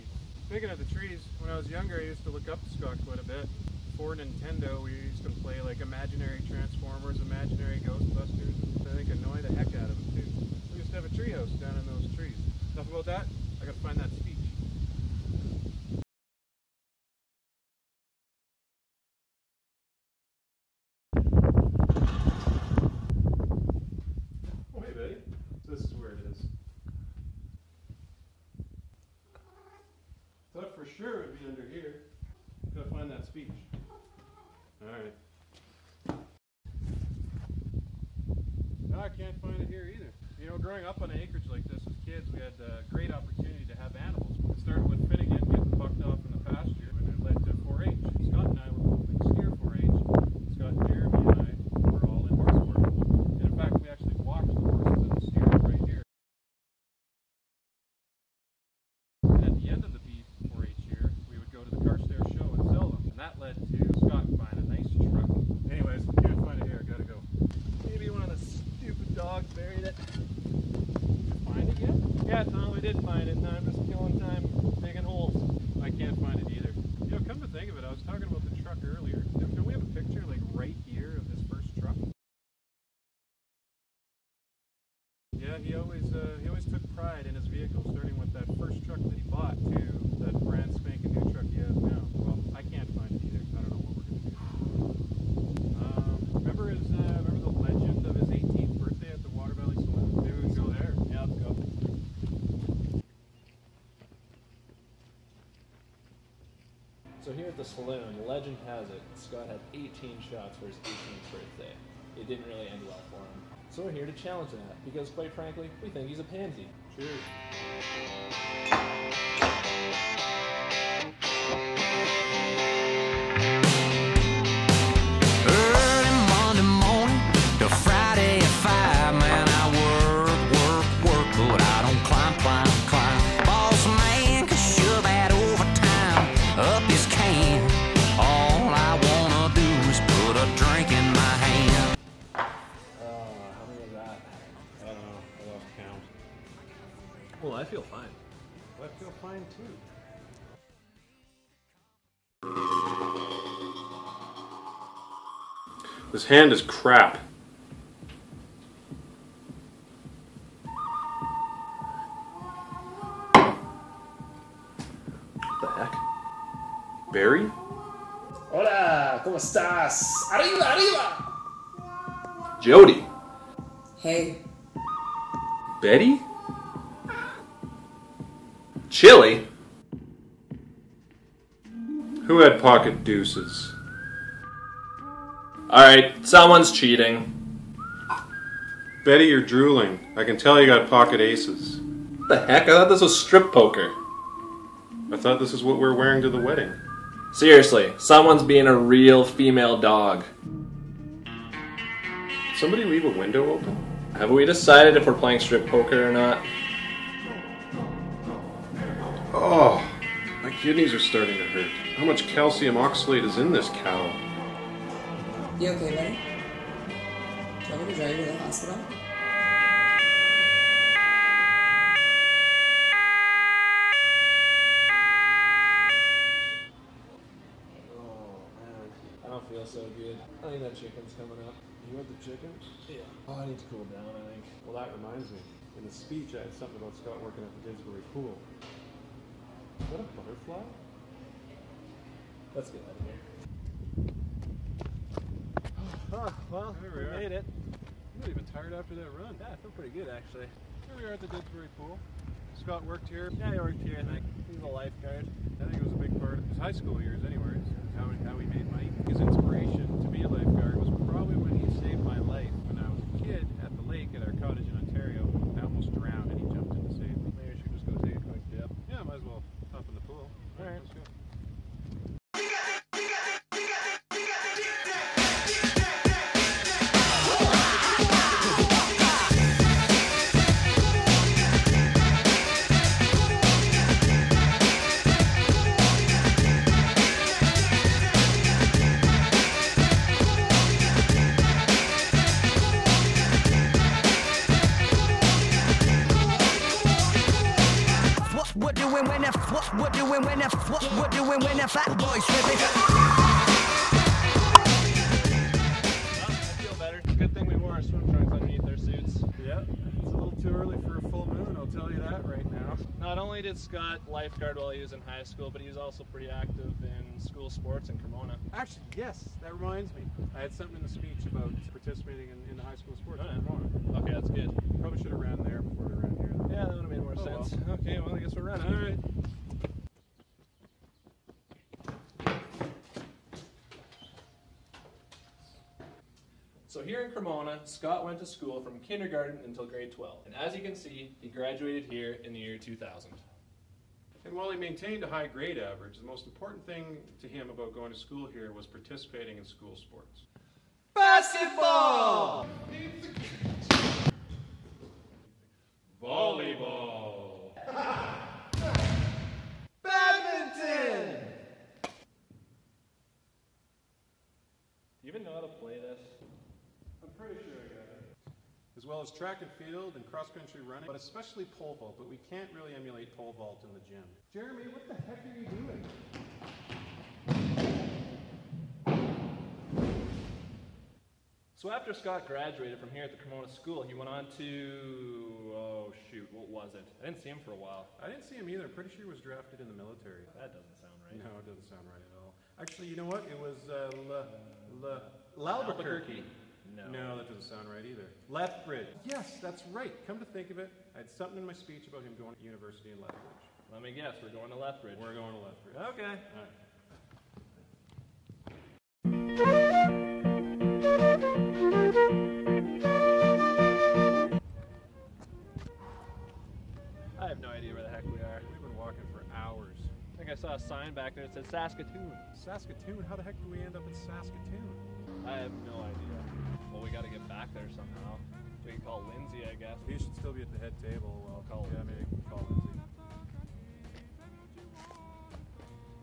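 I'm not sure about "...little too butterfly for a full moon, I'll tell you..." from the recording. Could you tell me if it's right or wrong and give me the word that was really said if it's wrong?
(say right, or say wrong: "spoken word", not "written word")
wrong: "early", not "butterfly".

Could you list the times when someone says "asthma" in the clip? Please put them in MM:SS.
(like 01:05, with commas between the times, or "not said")
not said.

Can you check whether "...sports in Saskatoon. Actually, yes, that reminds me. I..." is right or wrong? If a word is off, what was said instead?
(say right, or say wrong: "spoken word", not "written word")
wrong: "Cremona", not "Saskatoon".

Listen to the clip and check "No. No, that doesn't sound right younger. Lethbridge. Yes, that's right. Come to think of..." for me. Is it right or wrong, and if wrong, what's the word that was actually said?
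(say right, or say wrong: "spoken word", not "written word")
wrong: "either", not "younger".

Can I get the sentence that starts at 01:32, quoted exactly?
Well, I can't find it either.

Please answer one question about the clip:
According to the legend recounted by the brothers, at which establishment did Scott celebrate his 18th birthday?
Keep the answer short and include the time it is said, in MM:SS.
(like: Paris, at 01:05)
Water Valley Saloon, at 01:39.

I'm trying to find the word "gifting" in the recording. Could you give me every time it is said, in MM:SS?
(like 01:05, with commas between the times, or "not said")
not said.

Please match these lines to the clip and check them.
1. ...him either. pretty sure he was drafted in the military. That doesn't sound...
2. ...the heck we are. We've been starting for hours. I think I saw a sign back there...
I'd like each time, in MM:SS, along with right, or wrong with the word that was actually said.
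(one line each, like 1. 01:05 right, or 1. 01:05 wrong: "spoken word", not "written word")
1. 06:28 right
2. 06:57 wrong: "walking", not "starting".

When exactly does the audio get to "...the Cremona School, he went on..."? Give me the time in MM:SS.
06:23.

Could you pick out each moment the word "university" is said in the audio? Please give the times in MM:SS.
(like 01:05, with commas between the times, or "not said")
06:42.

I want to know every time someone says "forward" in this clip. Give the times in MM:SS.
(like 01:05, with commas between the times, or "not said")
not said.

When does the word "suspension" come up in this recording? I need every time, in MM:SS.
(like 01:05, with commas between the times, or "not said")
not said.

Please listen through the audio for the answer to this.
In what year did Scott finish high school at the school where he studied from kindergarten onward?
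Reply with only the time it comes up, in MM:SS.
05:42.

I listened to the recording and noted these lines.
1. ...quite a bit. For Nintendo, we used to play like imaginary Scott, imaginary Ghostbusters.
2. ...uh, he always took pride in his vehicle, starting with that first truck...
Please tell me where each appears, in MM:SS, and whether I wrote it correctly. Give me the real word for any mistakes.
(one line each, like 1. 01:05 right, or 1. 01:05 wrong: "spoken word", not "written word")
1. 00:03 wrong: "Transformers", not "Scott"
2. 01:26 right.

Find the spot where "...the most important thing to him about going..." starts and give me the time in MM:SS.
05:45.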